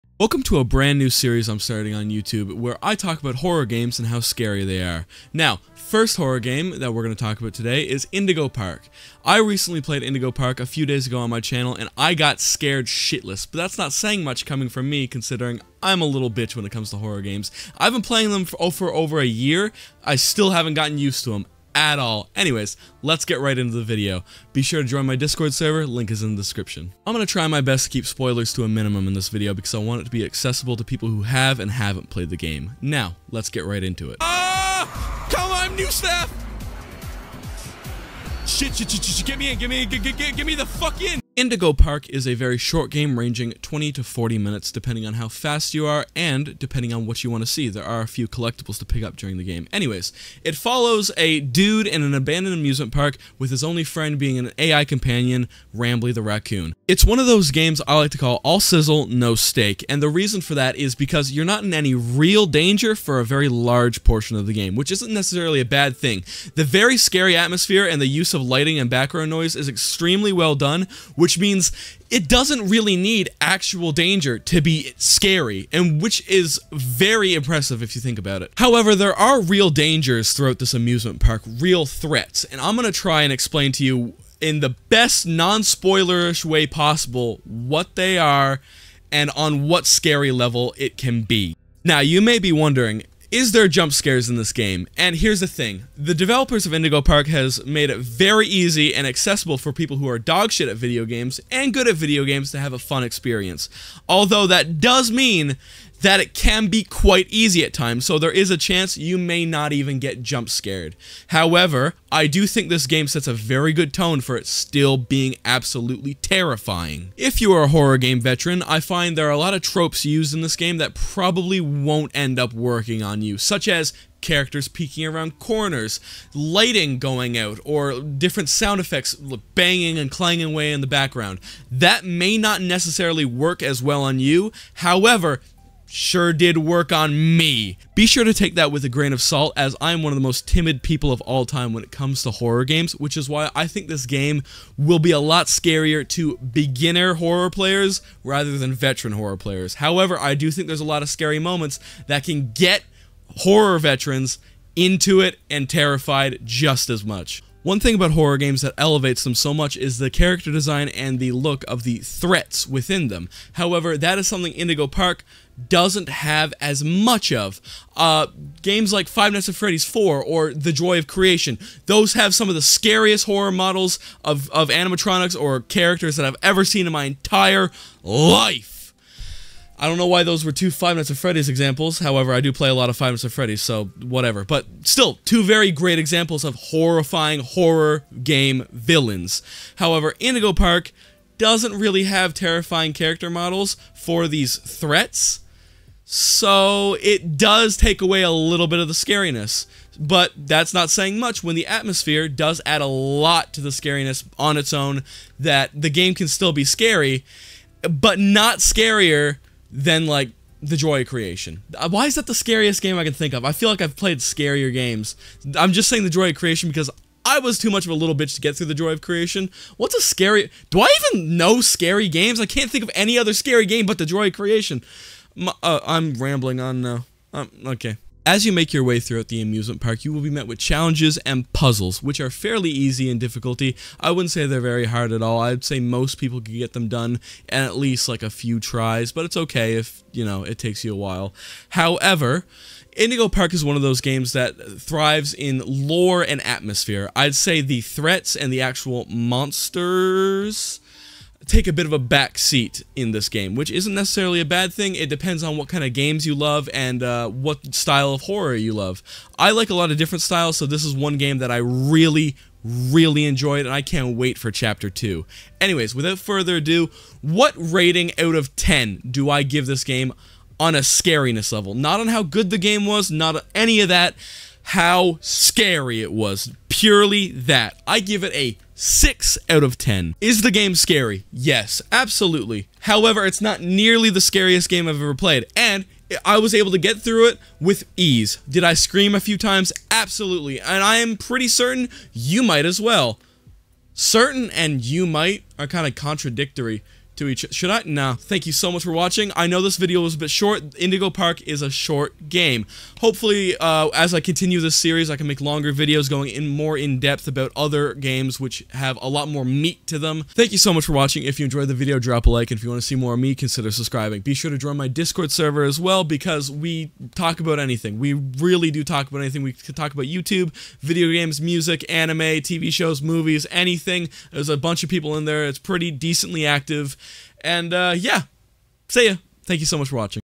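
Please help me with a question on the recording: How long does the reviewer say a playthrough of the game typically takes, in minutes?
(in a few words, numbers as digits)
20 to 40 minutes.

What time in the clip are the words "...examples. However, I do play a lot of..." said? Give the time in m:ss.
3:01.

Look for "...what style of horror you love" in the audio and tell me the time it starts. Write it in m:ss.
4:17.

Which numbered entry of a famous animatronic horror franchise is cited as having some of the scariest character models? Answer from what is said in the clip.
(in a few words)
Five Nights at Freddy's 4.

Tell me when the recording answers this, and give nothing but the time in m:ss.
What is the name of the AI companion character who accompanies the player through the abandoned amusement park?
0:55.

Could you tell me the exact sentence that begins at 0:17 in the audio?
I've been playing them for, oh, over a year, I still haven't gotten used to them at all.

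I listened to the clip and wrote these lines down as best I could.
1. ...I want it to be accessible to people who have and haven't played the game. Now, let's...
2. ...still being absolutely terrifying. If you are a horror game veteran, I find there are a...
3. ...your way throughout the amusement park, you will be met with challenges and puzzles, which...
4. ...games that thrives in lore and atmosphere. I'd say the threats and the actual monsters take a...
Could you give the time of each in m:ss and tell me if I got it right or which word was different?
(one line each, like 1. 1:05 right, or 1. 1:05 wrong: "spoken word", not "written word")
1. 0:29 right
2. 1:54 right
3. 3:48 right
4. 4:04 right.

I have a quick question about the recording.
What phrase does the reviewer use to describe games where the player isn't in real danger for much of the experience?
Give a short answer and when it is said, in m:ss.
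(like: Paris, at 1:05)
all sizzle, no steak, at 0:58.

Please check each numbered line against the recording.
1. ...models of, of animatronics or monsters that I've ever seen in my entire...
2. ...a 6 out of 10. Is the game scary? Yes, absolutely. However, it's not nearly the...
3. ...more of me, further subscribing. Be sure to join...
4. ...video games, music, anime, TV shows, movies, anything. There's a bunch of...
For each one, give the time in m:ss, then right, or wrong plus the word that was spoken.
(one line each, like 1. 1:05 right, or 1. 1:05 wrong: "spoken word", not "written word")
1. 2:53 wrong: "characters", not "monsters"
2. 4:38 right
3. 5:12 wrong: "consider", not "further"
4. 5:20 right.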